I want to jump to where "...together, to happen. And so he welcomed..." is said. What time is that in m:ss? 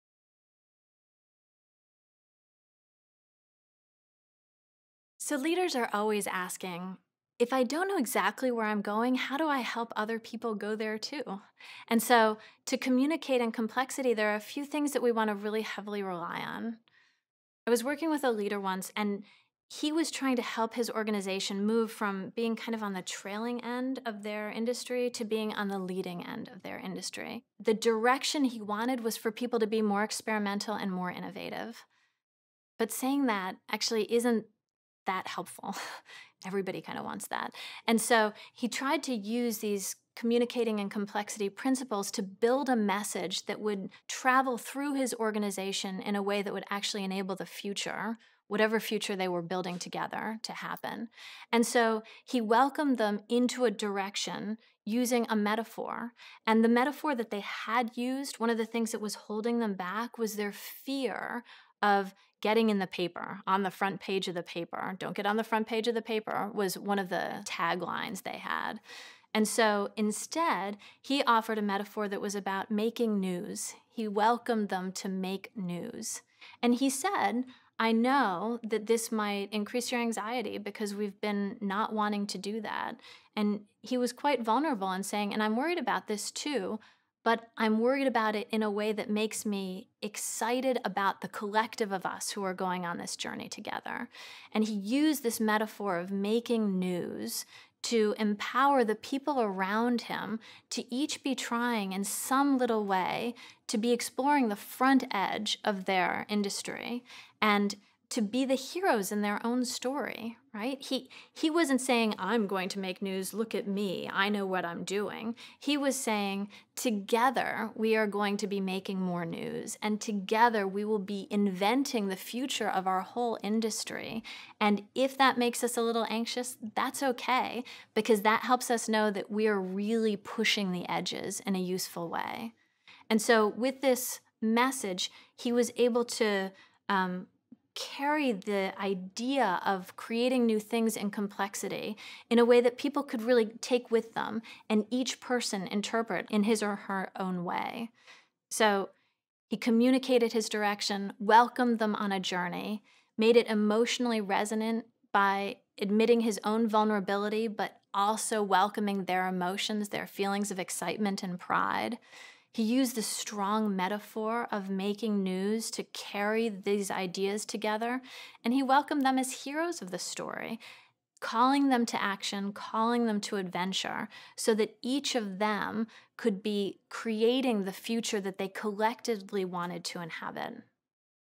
0:49.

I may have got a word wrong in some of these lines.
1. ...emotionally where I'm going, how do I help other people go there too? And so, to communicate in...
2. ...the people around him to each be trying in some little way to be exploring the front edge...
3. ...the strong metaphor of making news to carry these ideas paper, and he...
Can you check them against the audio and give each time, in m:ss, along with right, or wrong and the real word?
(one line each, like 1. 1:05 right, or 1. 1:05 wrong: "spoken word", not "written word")
1. 0:07 wrong: "exactly", not "emotionally"
2. 1:38 right
3. 2:42 wrong: "together", not "paper".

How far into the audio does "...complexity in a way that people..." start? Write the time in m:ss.
2:21.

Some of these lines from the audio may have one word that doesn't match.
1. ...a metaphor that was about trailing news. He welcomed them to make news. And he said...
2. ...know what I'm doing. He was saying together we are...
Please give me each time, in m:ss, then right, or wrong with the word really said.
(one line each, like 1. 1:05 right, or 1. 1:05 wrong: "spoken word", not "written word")
1. 1:11 wrong: "making", not "trailing"
2. 1:54 right.